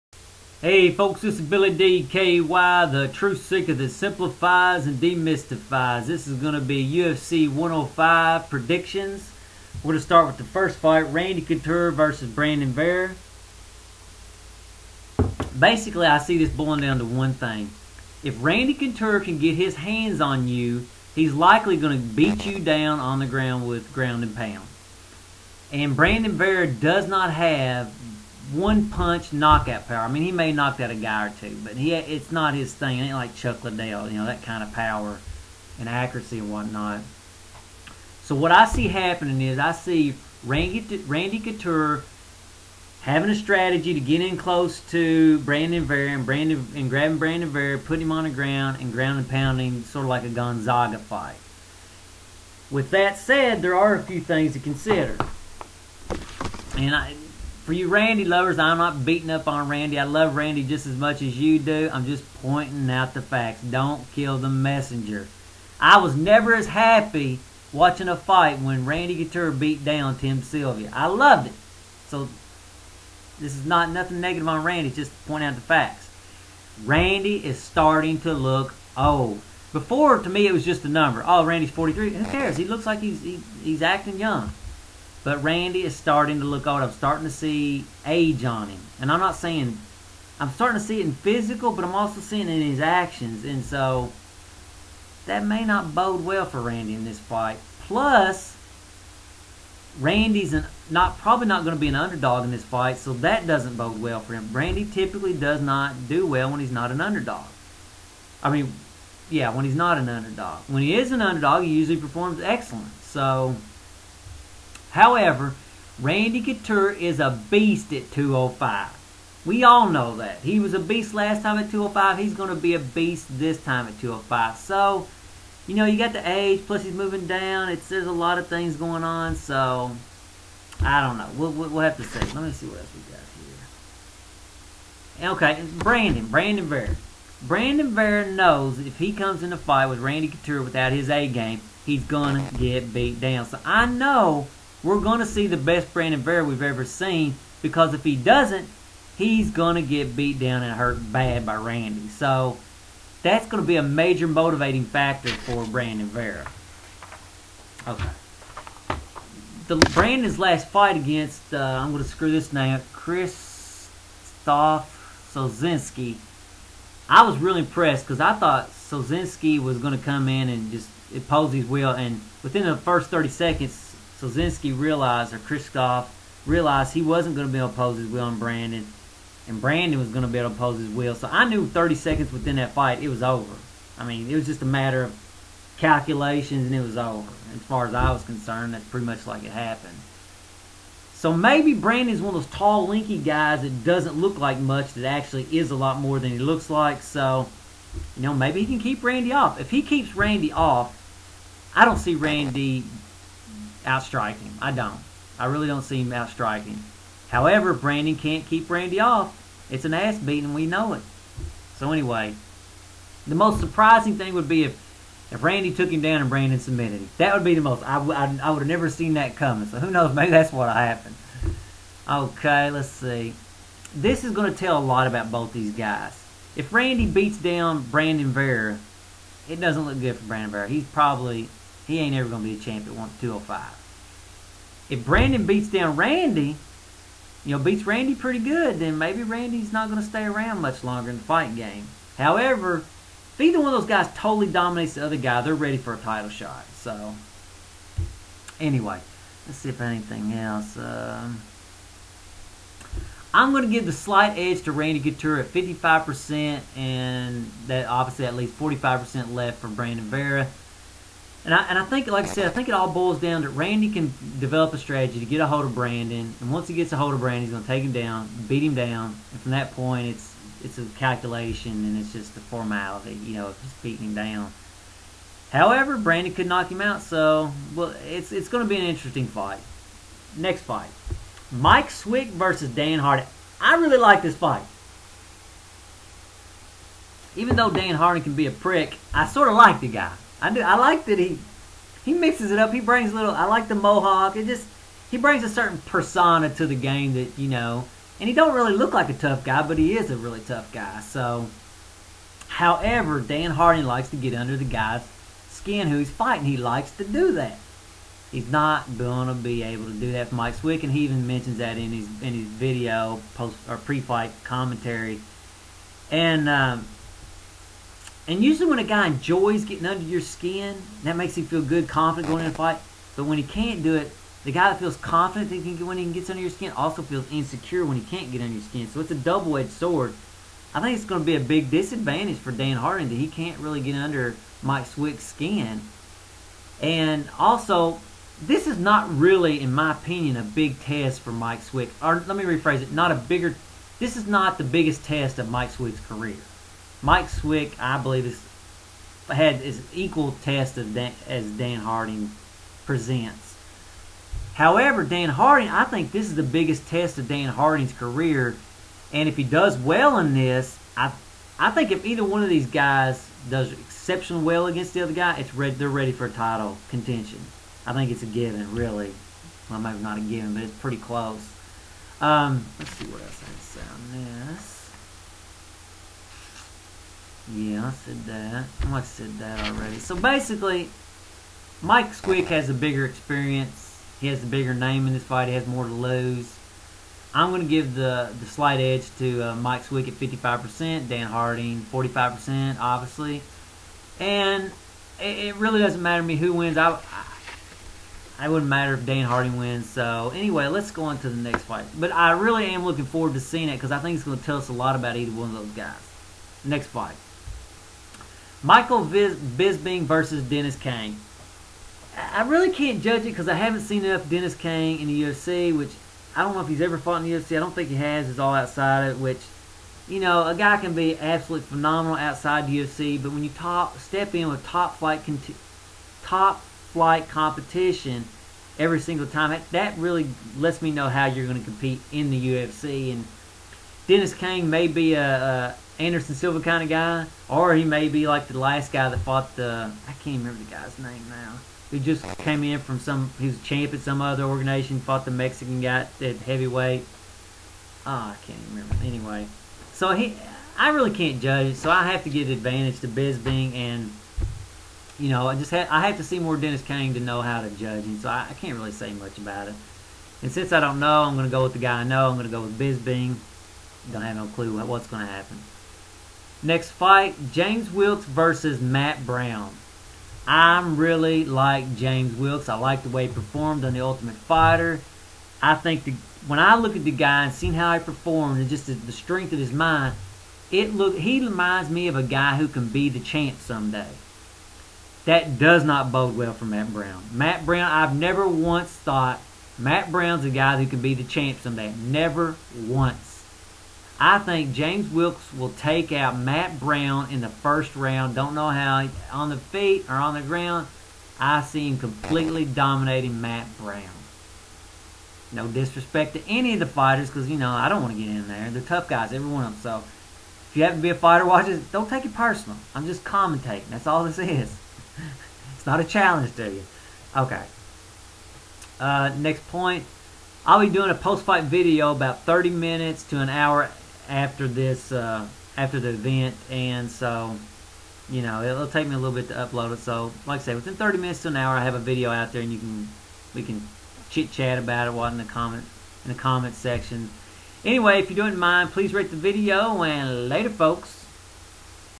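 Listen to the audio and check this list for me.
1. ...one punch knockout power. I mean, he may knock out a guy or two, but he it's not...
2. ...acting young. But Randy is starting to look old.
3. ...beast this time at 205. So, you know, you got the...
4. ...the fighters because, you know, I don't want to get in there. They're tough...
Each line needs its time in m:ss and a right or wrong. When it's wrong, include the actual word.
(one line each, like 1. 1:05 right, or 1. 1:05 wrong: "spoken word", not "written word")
1. 0:28 right
2. 1:23 right
3. 2:02 right
4. 8:26 right.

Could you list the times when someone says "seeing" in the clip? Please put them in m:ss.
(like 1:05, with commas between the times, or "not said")
1:32, 6:43.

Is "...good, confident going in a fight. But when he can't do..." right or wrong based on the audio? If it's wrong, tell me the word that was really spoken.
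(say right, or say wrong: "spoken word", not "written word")
right.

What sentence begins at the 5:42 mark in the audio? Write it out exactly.
Or let me rephrase it: not a bigger.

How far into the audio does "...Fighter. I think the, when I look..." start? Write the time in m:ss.
7:54.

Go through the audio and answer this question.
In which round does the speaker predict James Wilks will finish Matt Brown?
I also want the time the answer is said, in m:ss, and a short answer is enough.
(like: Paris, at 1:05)
First round, at 8:17.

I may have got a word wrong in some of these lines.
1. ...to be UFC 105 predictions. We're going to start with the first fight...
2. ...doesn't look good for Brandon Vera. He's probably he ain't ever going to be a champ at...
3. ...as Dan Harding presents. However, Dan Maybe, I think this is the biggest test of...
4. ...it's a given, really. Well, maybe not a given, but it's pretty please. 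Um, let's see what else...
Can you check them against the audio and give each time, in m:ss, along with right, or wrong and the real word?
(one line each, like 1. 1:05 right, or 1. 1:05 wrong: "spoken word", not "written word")
1. 0:06 right
2. 3:49 right
3. 5:51 wrong: "Harding", not "Maybe"
4. 6:08 wrong: "close", not "please".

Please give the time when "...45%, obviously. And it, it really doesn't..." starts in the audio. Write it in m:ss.
6:31.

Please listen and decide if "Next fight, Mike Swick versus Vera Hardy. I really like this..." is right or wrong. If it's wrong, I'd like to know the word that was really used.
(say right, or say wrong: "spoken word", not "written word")
wrong: "Dan", not "Vera".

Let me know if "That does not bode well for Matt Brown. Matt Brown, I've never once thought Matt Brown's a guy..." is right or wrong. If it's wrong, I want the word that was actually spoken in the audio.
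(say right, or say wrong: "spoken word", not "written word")
right.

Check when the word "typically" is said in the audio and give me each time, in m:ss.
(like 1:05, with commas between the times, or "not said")
1:44.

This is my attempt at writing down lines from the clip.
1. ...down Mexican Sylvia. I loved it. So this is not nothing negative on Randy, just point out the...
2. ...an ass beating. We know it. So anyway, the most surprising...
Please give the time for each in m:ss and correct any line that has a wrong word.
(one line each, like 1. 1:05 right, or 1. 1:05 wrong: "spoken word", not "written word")
1. 1:09 wrong: "Tim", not "Mexican"
2. 3:29 right.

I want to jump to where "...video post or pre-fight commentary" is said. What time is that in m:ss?
5:12.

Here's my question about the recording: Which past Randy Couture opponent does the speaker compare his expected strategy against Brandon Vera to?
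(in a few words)
Gonzaga.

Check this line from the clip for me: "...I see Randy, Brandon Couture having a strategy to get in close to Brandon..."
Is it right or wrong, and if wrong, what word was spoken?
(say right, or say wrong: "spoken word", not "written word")
wrong: "Randy", not "Brandon".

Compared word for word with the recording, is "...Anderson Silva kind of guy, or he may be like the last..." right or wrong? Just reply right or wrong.
right.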